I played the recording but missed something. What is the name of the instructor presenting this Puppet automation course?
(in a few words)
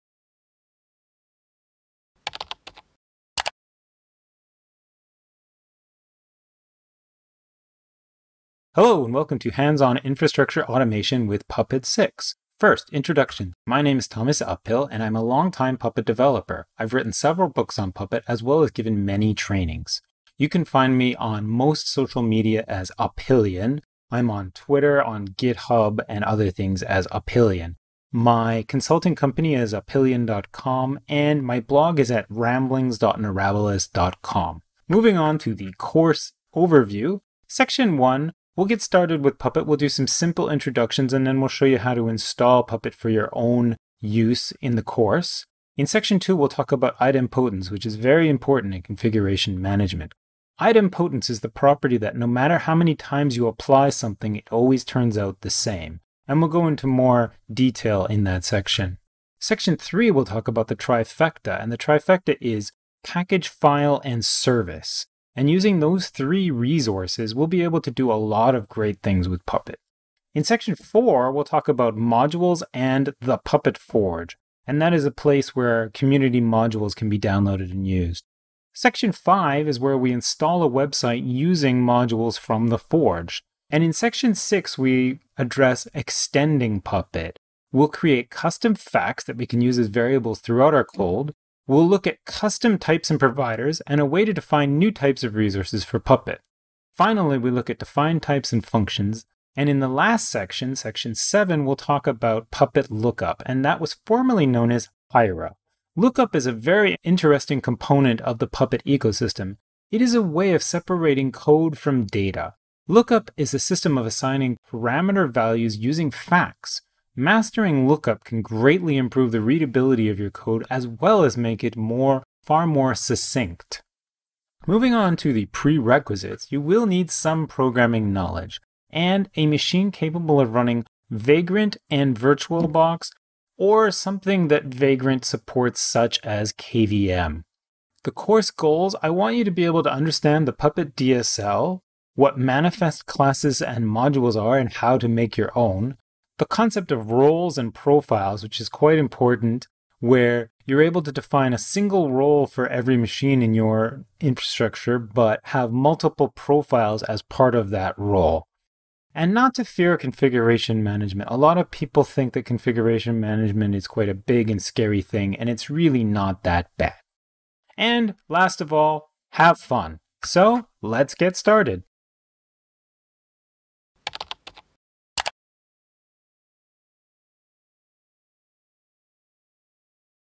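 Thomas Uphill.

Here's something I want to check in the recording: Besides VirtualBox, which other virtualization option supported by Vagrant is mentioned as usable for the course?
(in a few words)
KVM.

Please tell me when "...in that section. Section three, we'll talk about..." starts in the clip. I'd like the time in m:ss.
0:58.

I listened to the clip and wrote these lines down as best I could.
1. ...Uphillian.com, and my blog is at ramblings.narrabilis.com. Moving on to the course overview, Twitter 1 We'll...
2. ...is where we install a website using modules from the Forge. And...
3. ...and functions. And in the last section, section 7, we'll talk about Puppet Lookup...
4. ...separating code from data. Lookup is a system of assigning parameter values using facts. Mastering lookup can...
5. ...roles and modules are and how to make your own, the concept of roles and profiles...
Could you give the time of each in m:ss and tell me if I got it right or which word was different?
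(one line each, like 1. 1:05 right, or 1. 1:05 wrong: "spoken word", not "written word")
1. 0:29 wrong: "Section", not "Twitter"
2. 1:19 right
3. 1:38 right
4. 1:50 right
5. 2:23 wrong: "classes", not "roles".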